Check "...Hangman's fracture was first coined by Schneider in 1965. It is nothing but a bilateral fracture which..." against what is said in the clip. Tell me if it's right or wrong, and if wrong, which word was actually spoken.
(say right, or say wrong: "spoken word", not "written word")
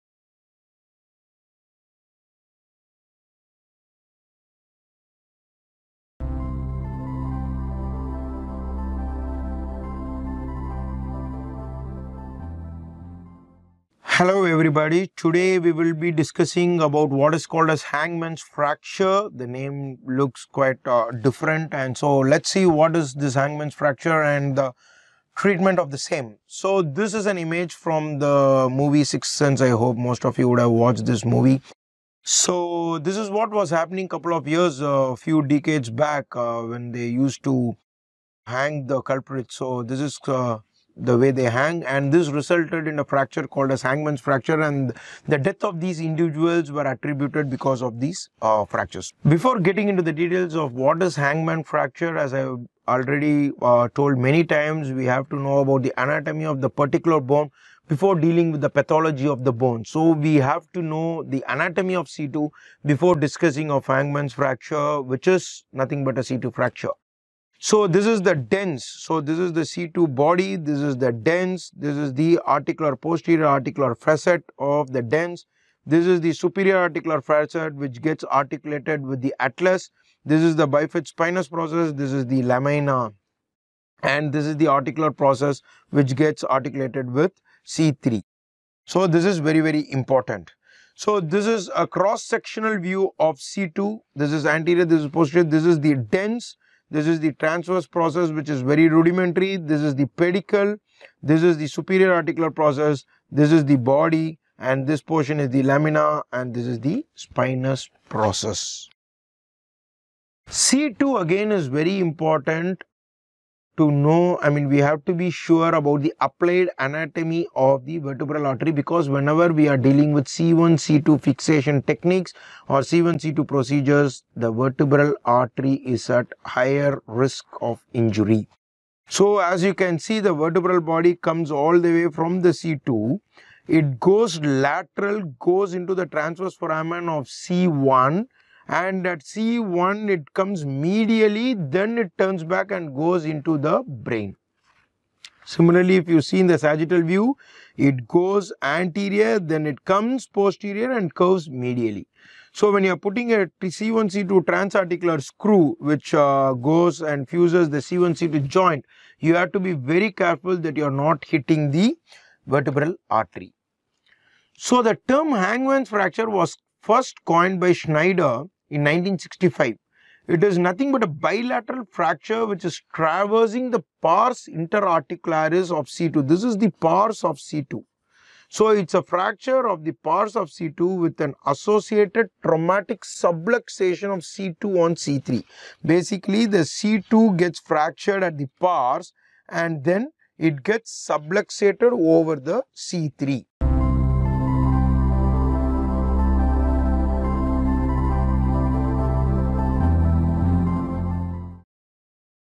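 right.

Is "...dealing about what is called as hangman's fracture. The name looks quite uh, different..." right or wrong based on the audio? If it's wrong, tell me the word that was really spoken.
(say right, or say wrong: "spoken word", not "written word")
wrong: "discussing", not "dealing".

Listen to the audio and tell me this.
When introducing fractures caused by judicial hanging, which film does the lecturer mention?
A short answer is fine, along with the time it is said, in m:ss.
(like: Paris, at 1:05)
Sixth Sense, at 0:29.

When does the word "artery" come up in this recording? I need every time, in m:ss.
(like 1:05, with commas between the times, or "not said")
1:58, 2:05, 2:43.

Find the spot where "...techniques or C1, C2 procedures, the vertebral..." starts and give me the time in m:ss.
2:01.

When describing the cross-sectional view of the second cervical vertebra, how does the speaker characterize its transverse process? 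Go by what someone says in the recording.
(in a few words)
very rudimentary.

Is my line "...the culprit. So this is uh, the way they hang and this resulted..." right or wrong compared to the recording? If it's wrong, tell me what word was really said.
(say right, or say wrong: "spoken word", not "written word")
right.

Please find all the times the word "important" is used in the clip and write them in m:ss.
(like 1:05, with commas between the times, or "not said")
1:29, 1:51.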